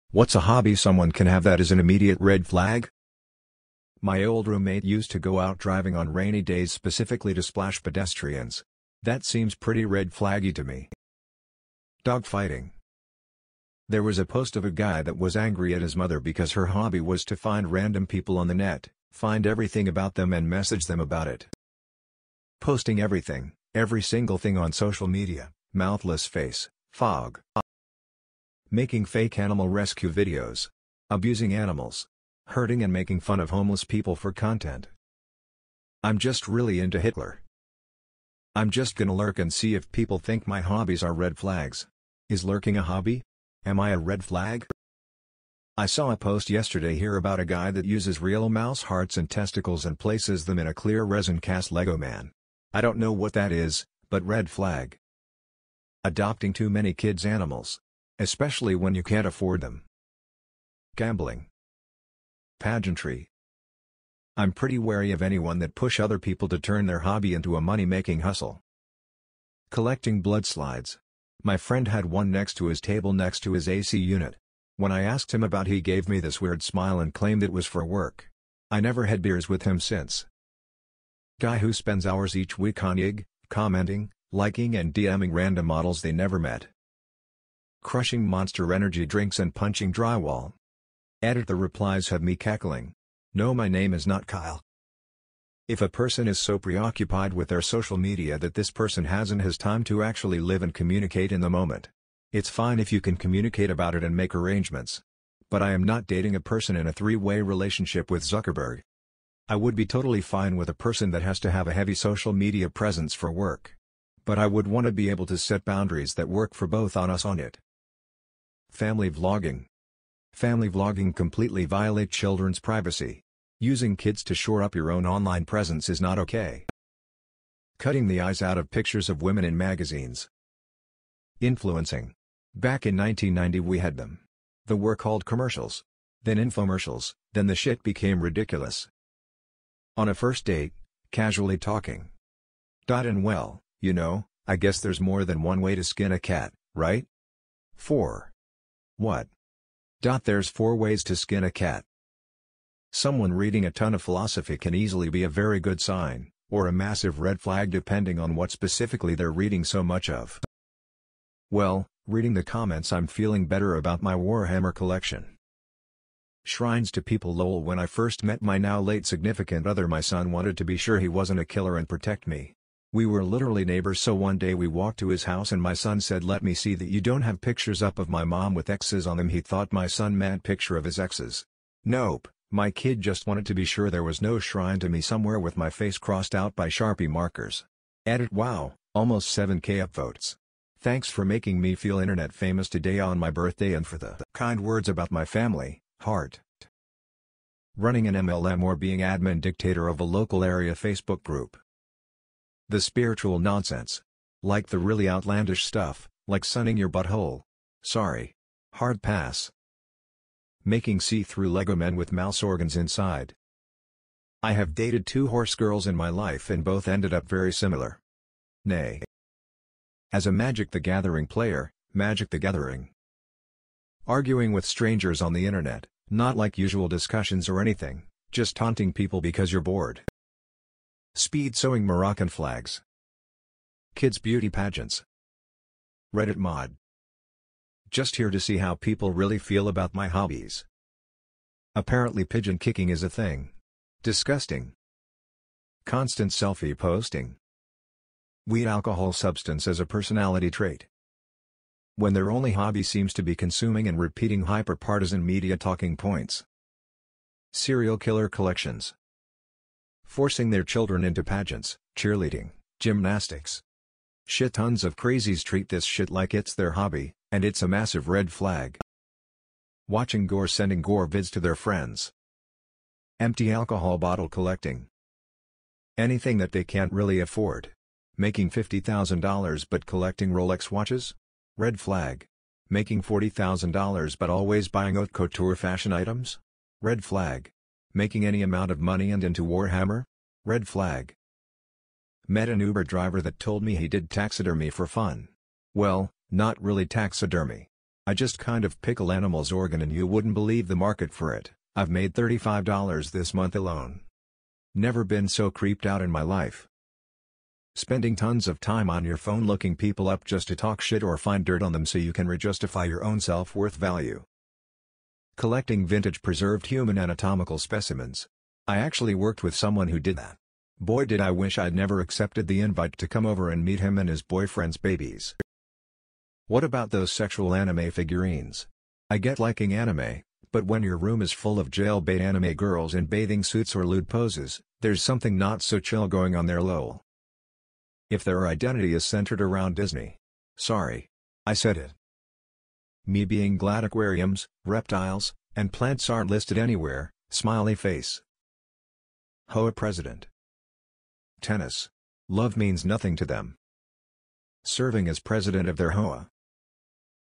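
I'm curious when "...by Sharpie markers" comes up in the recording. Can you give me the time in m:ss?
3:06.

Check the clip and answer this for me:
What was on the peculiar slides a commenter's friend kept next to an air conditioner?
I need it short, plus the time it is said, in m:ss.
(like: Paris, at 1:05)
blood, at 1:10.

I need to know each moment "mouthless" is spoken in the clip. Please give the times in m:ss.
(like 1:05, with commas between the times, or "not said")
0:25.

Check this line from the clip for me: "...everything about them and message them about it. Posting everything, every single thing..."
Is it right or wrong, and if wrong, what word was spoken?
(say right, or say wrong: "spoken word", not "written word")
right.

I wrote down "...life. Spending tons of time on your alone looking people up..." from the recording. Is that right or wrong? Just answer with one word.
wrong.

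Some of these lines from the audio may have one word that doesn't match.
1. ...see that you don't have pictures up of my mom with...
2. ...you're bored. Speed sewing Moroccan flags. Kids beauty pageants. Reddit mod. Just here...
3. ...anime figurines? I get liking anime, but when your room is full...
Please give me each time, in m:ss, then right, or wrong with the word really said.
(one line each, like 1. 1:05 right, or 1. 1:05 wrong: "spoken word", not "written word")
1. 2:56 right
2. 3:49 right
3. 5:27 right.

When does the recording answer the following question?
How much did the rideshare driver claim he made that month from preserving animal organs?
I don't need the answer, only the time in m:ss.
5:02.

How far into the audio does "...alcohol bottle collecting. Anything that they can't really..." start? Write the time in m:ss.
4:33.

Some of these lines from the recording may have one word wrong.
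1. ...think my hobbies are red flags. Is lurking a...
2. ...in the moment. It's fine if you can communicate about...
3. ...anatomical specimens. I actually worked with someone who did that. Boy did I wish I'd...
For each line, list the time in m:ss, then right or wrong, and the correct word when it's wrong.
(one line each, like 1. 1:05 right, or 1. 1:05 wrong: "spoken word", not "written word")
1. 0:40 right
2. 1:41 right
3. 5:16 right.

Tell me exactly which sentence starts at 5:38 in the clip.
If their identity is centered around Disney.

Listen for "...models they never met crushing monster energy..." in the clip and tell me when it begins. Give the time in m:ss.
1:25.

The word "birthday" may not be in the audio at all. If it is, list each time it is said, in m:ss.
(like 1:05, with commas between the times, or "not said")
3:13.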